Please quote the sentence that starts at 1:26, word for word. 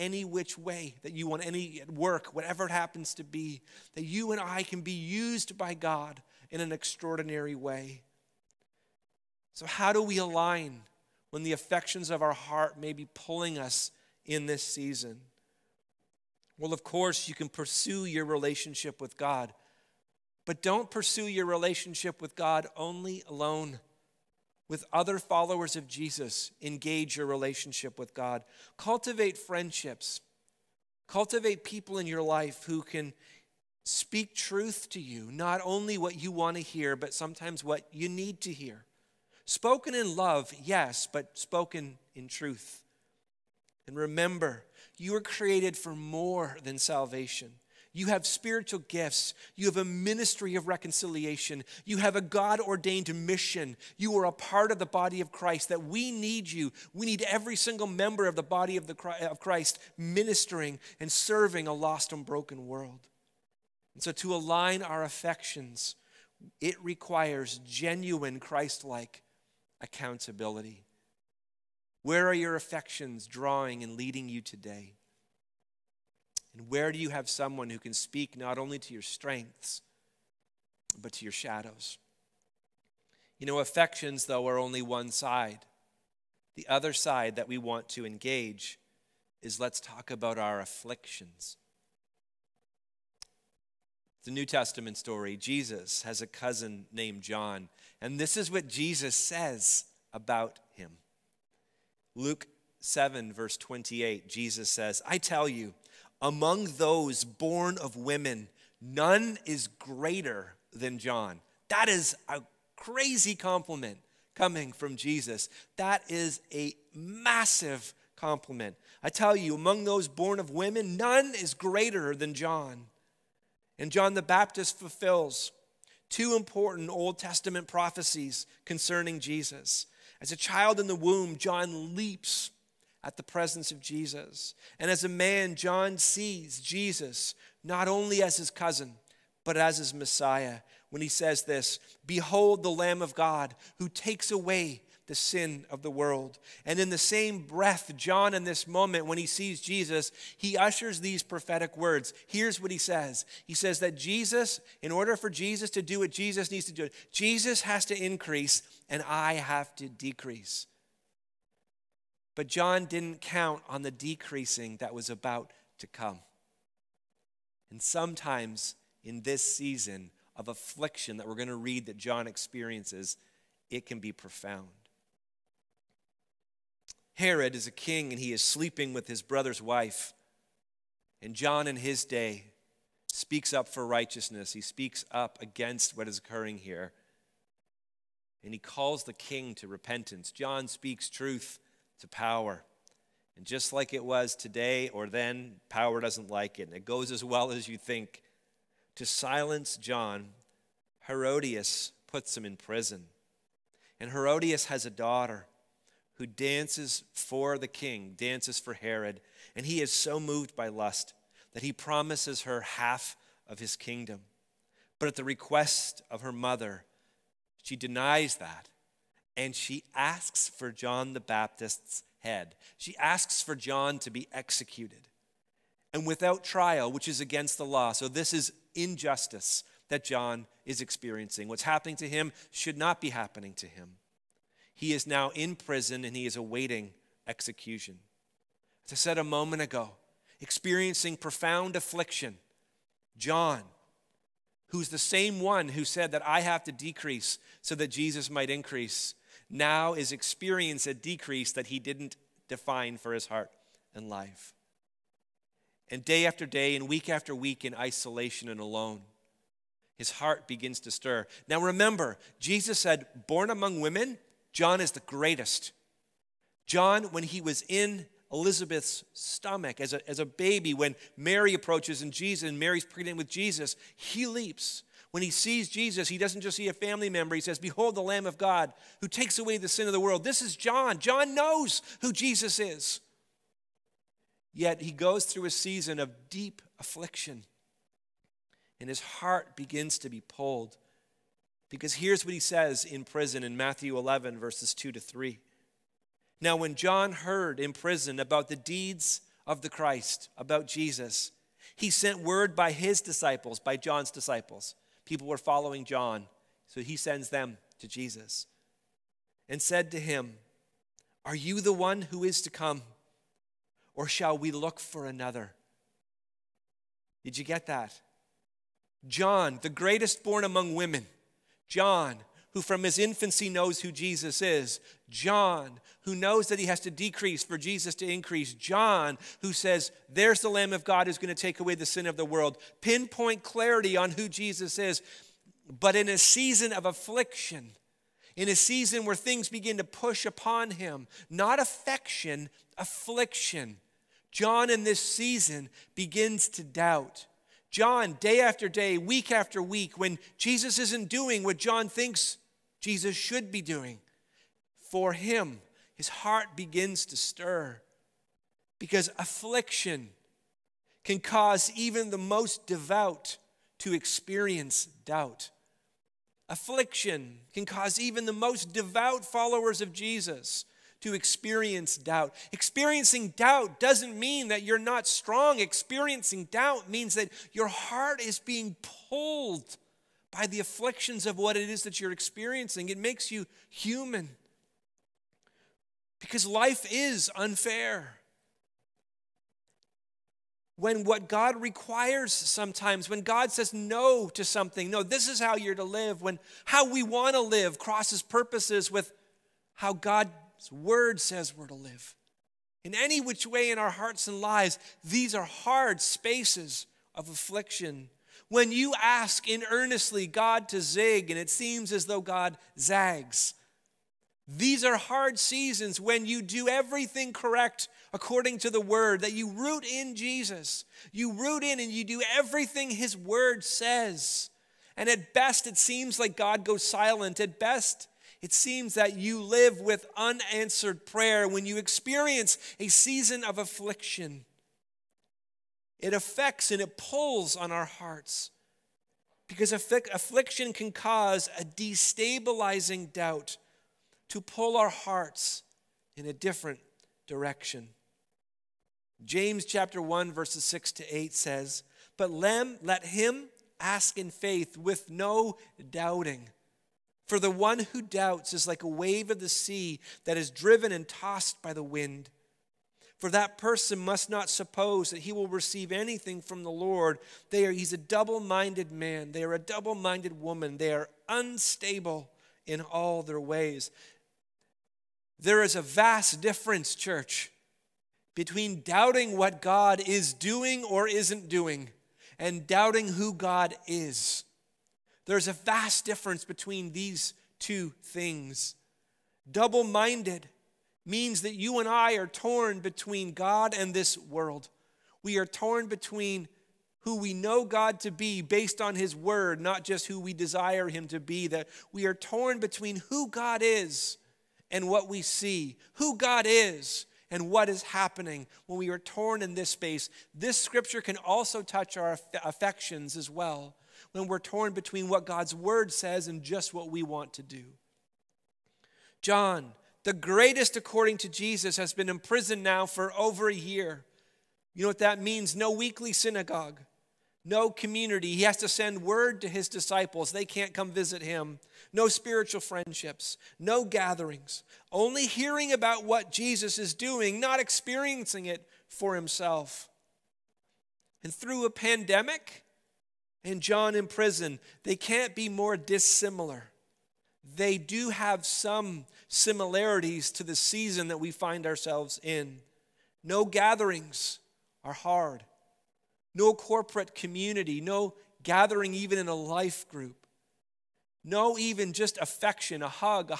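The other side that we want to engage is let's talk about our afflictions.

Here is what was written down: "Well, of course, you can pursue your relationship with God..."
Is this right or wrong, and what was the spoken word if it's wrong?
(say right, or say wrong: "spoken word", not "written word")
right.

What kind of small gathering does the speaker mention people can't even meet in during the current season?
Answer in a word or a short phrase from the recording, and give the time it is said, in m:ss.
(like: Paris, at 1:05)
Life group, at 9:19.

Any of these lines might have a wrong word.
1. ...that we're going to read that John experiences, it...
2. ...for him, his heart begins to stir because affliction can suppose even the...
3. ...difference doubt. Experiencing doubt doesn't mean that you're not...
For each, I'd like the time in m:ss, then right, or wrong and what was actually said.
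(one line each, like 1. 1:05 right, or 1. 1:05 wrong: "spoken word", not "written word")
1. 2:51 right
2. 5:54 wrong: "cause", not "suppose"
3. 6:11 wrong: "experience", not "difference".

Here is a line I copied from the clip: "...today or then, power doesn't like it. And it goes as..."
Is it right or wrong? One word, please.
right.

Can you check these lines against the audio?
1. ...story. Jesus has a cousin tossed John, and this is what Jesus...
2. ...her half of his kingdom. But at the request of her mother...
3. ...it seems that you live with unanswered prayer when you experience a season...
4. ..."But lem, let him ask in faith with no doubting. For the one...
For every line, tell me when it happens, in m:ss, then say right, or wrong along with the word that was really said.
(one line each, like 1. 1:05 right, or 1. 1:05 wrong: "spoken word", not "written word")
1. 1:34 wrong: "named", not "tossed"
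2. 3:32 right
3. 7:08 right
4. 7:32 right.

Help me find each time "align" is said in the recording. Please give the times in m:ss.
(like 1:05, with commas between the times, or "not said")
0:10, 1:04.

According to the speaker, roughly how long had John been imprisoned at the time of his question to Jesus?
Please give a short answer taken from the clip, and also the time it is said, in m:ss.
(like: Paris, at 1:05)
Over a year, at 8:43.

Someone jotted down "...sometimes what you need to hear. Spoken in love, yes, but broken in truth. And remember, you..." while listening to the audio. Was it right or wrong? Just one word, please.
wrong.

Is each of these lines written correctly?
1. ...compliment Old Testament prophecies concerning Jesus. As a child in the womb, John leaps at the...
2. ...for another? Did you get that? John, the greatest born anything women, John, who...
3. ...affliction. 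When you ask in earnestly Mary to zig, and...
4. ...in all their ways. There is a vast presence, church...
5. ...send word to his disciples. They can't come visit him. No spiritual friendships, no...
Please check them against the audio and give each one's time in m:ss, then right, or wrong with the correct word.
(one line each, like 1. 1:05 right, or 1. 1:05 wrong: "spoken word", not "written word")
1. 2:06 wrong: "important", not "compliment"
2. 5:14 wrong: "among", not "anything"
3. 6:47 wrong: "God", not "Mary"
4. 7:52 wrong: "difference", not "presence"
5. 8:48 right.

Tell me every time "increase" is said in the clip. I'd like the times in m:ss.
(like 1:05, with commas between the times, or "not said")
2:37, 4:08, 5:28.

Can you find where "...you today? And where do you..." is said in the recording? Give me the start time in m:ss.
1:14.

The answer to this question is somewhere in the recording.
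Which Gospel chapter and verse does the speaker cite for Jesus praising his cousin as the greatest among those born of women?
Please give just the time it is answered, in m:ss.
1:42.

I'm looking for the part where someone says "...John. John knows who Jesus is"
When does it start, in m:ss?
4:40.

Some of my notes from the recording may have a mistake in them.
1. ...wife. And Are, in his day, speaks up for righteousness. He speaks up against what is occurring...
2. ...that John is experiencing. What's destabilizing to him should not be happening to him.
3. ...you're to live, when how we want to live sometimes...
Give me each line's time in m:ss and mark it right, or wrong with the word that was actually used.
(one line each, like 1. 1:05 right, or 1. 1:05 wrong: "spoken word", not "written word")
1. 2:59 wrong: "John", not "Are"
2. 3:49 wrong: "happening", not "destabilizing"
3. 6:35 wrong: "crosses", not "sometimes".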